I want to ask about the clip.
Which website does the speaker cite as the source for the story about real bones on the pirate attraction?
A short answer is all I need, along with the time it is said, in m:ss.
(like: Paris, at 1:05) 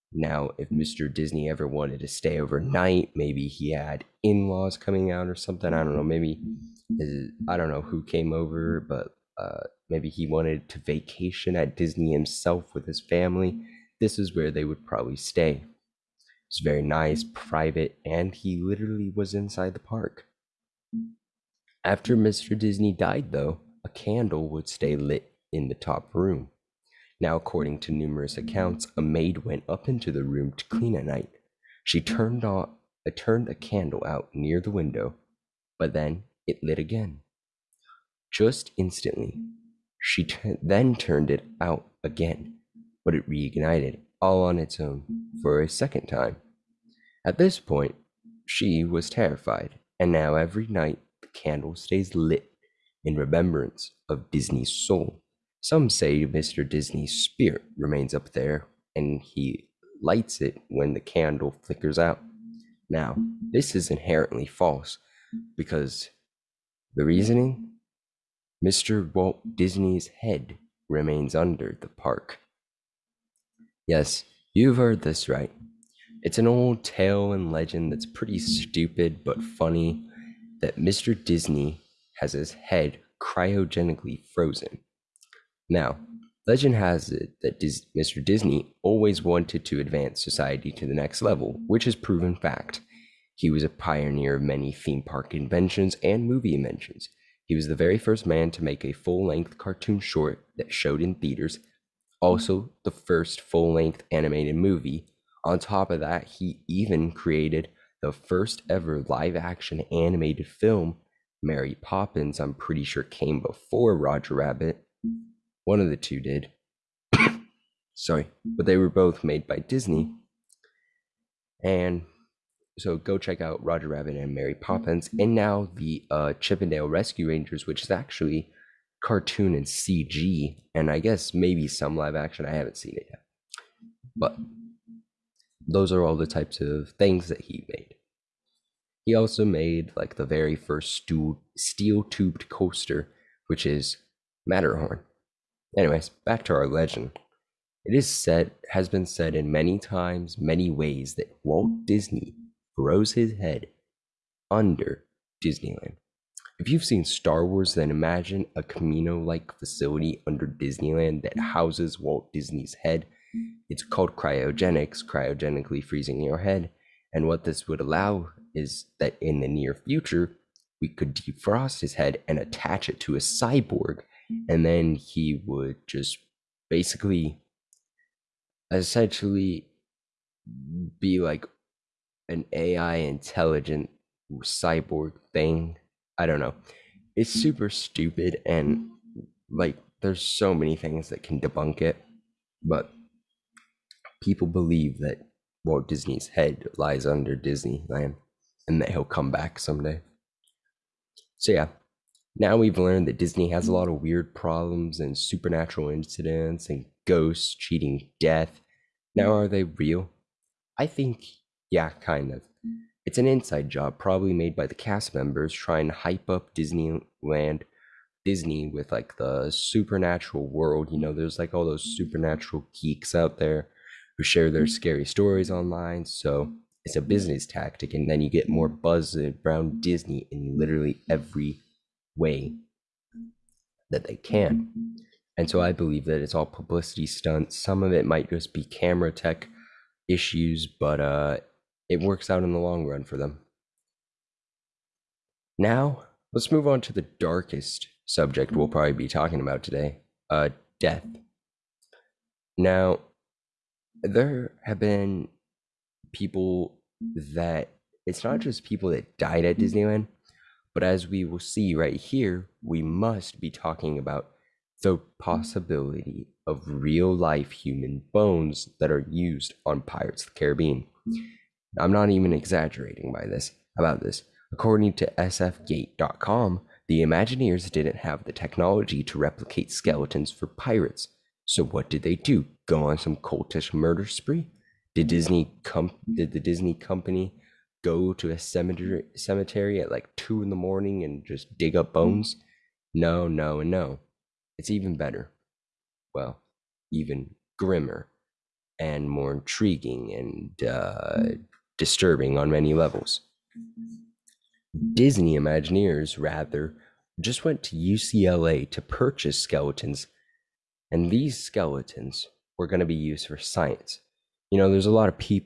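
sfgate.com, at 4:35.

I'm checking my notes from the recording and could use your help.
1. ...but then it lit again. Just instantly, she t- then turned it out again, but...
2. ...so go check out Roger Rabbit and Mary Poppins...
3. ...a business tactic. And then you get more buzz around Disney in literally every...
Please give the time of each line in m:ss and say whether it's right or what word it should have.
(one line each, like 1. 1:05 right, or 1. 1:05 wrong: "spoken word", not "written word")
1. 0:35 right
2. 2:02 right
3. 3:46 right.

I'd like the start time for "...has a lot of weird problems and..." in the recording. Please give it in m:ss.
3:23.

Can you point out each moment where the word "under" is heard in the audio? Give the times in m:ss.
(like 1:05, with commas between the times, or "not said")
1:11, 2:34, 2:40, 3:17.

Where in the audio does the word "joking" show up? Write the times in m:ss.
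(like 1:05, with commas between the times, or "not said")
not said.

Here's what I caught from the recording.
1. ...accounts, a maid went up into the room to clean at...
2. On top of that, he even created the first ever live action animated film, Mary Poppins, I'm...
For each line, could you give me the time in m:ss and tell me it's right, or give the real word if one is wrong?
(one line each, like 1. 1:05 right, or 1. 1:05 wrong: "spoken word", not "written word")
1. 0:28 right
2. 1:45 right.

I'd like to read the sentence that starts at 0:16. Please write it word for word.
It's very nice, private, and he literally was inside the park.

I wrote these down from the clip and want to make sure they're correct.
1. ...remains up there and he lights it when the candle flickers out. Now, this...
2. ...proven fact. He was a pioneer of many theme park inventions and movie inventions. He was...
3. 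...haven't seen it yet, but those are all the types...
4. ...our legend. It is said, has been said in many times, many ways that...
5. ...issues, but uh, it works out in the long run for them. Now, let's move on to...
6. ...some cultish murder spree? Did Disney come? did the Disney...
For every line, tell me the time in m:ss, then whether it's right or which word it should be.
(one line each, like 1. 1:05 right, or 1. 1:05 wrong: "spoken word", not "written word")
1. 0:57 right
2. 1:31 right
3. 2:12 right
4. 2:26 right
5. 4:00 right
6. 4:42 right.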